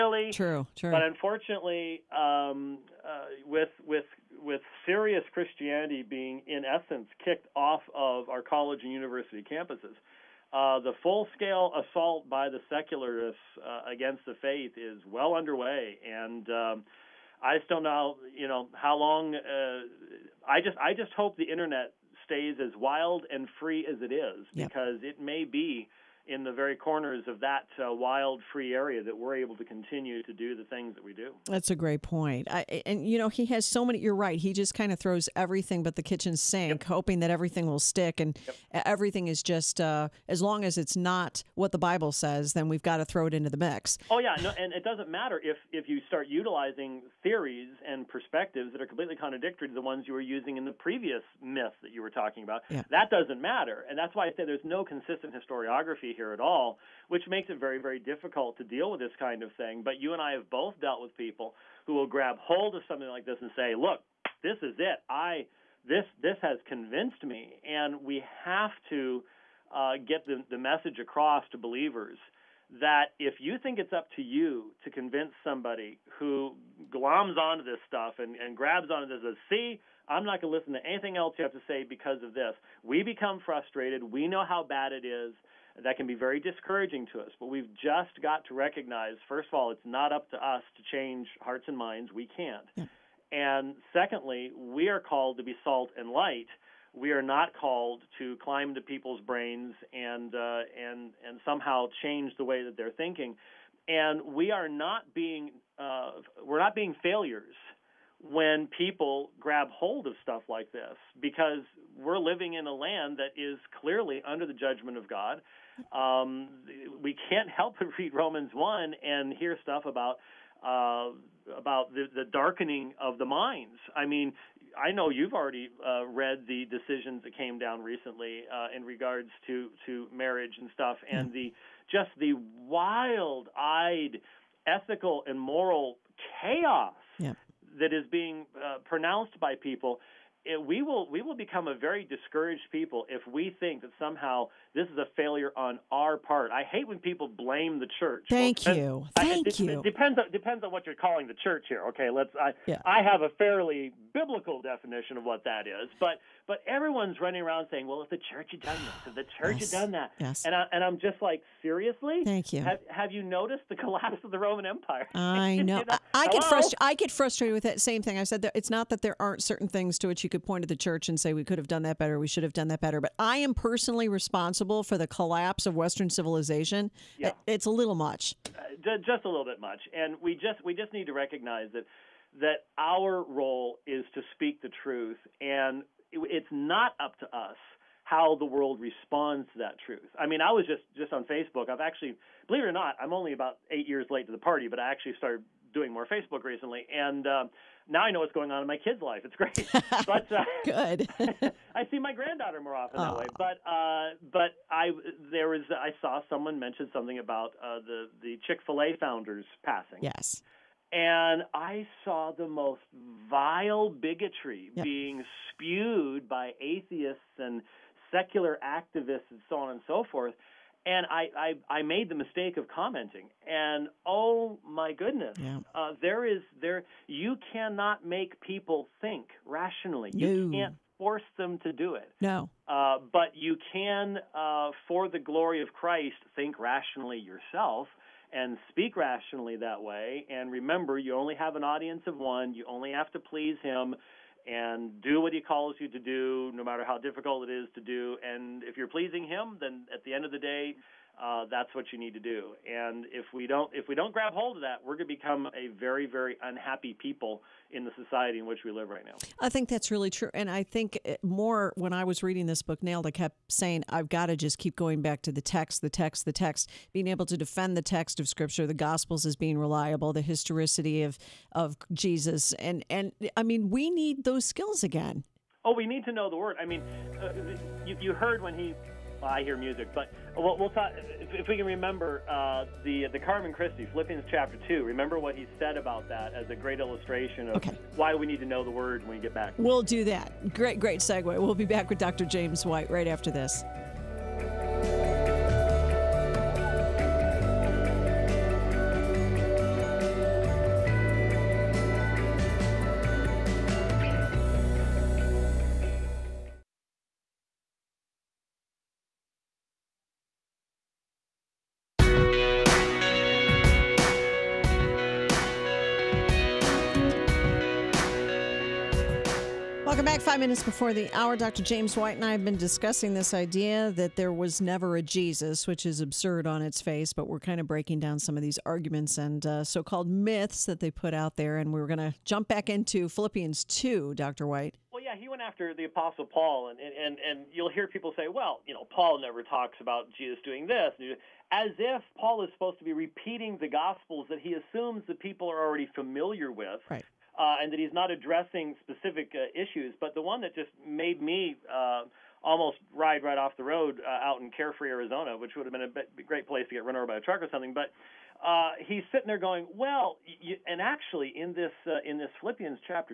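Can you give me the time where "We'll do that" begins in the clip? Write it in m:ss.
4:49.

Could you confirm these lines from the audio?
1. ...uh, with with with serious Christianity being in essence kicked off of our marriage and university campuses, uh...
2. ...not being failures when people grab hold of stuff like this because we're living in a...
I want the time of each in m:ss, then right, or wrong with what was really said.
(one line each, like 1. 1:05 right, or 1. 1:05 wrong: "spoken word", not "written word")
1. 0:03 wrong: "college", not "marriage"
2. 1:46 right.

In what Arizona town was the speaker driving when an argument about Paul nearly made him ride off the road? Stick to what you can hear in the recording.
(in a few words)
Carefree.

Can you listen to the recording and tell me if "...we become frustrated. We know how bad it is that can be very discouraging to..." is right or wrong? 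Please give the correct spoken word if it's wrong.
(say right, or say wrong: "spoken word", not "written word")
right.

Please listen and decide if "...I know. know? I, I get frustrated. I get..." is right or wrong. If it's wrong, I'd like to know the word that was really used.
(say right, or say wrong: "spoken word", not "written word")
right.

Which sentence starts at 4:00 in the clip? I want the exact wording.
And remember, you only have an audience of one.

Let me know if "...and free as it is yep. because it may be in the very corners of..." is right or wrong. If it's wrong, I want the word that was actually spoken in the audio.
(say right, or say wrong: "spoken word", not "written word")
right.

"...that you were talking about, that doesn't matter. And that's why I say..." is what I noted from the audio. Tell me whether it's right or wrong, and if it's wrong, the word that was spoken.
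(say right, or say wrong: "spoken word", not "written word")
right.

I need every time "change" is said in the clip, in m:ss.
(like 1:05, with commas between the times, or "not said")
1:30, 1:42.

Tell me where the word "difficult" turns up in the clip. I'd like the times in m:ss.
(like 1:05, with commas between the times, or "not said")
0:57, 4:06.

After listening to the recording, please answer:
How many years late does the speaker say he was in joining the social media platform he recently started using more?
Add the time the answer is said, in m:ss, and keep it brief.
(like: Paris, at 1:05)
8, at 3:13.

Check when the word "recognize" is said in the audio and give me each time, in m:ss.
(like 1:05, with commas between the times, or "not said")
1:28, 3:01.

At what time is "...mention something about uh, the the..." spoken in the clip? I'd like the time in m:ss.
3:26.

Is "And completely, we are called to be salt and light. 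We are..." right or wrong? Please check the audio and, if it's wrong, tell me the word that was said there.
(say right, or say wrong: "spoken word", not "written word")
wrong: "secondly", not "completely".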